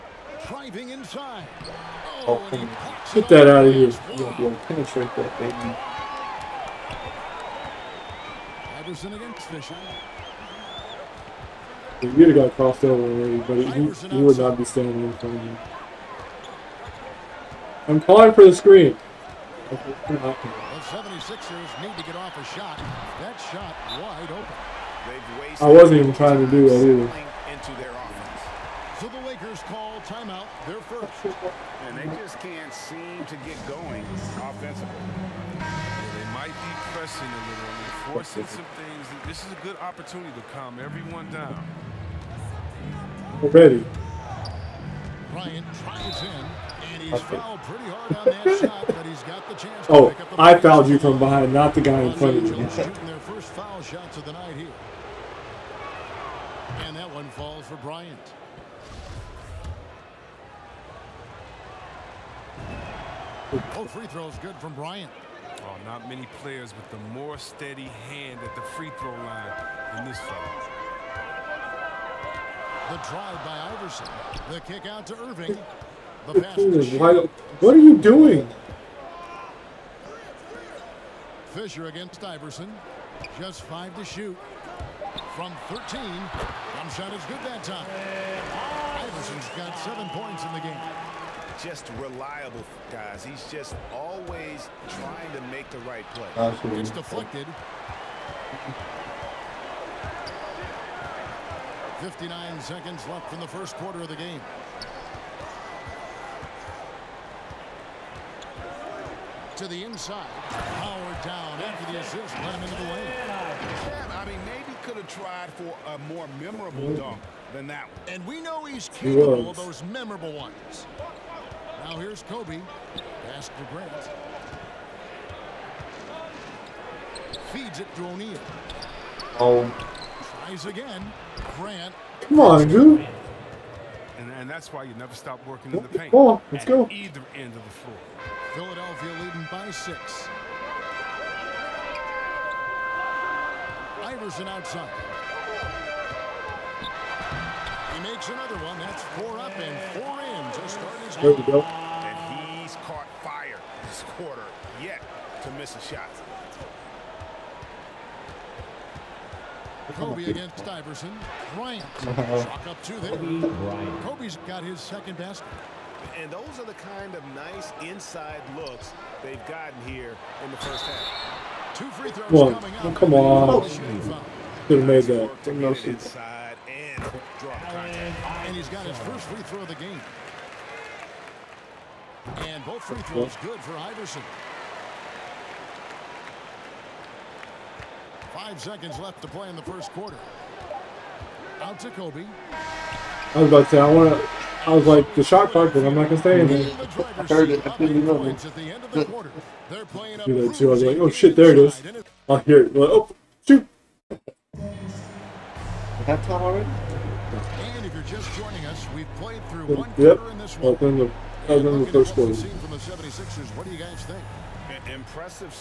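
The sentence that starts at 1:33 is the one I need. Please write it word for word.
He's just always trying to make the right play.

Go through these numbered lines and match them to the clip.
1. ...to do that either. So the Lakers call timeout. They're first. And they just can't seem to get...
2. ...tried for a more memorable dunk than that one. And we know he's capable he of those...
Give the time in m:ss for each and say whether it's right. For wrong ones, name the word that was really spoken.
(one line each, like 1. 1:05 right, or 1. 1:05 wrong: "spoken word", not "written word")
1. 0:26 right
2. 1:55 right.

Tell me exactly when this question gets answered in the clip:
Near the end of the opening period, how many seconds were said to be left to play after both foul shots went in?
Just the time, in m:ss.
3:08.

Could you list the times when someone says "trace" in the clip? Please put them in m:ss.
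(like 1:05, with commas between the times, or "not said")
not said.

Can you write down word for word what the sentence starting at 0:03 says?
You won't be able to penetrate that, baby.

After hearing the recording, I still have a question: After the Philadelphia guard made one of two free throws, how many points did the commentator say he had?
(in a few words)
7.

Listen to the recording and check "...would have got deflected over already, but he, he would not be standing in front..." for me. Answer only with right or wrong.
wrong.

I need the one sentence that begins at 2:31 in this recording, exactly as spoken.
And he's caught fire this quarter, yet to miss a shot.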